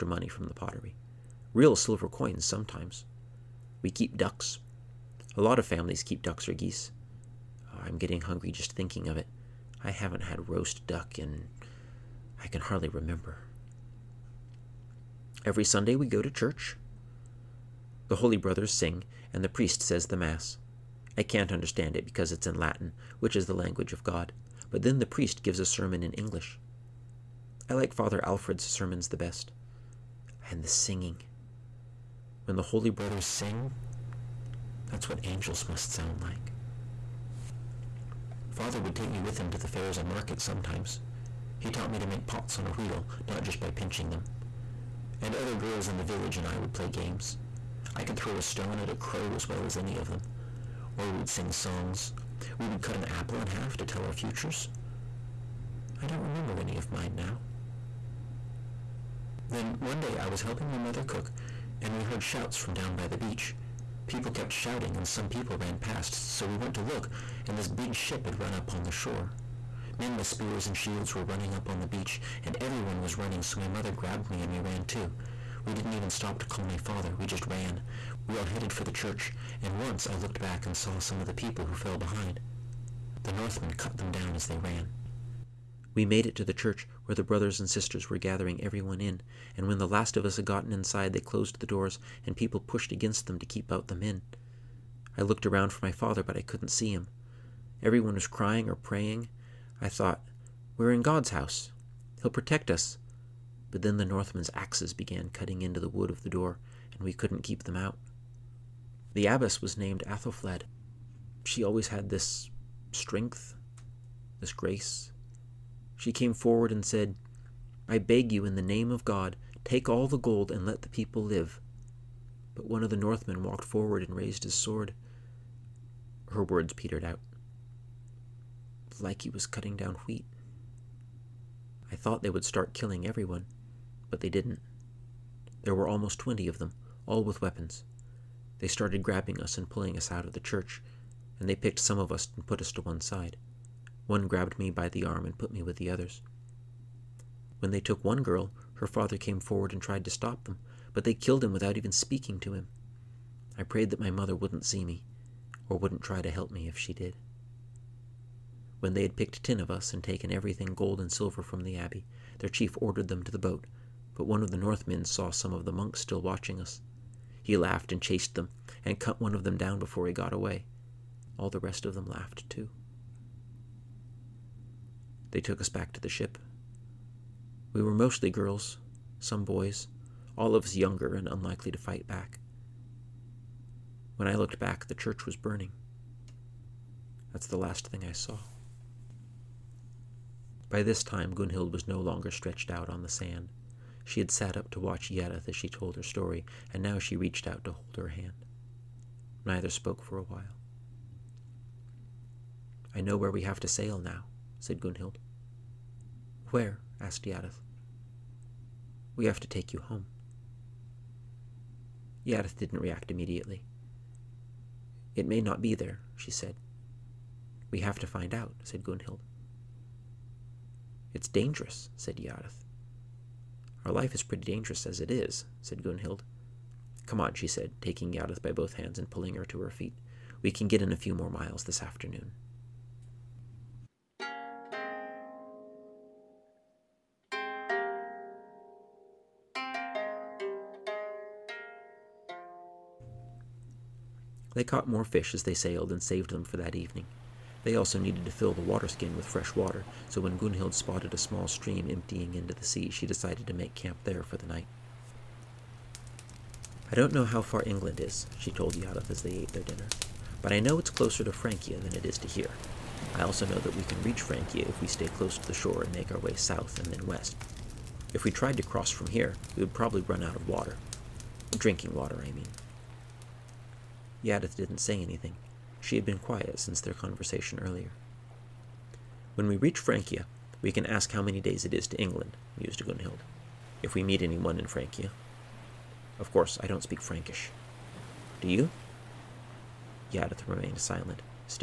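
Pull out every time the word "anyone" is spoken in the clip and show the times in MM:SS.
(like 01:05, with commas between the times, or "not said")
04:44.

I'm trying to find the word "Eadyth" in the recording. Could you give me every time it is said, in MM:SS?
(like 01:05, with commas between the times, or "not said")
03:15, 03:27, 03:32, 03:42, 03:48, 04:18, 04:34, 04:50.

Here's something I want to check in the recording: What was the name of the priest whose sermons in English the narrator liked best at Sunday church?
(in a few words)
Father Alfred.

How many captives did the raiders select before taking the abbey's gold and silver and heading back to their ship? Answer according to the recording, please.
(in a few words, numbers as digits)
10.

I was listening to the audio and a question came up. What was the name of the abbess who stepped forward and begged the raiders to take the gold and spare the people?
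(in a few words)
Athelfled.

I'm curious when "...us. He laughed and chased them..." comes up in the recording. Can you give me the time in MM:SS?
02:46.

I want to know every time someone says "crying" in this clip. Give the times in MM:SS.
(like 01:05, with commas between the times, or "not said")
01:38.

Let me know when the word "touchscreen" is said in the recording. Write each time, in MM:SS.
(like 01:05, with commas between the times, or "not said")
not said.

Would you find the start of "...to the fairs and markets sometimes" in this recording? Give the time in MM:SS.
00:39.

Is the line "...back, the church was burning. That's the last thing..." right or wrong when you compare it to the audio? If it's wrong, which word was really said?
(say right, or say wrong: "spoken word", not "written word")
right.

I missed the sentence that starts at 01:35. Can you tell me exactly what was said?
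I looked around for my father, but I couldn't see him.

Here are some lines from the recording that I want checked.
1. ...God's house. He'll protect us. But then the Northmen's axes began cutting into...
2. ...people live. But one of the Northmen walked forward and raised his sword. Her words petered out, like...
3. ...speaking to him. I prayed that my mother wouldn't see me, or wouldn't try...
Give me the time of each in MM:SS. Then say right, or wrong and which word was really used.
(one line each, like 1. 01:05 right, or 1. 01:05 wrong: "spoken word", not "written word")
1. 01:41 right
2. 02:00 right
3. 02:31 right.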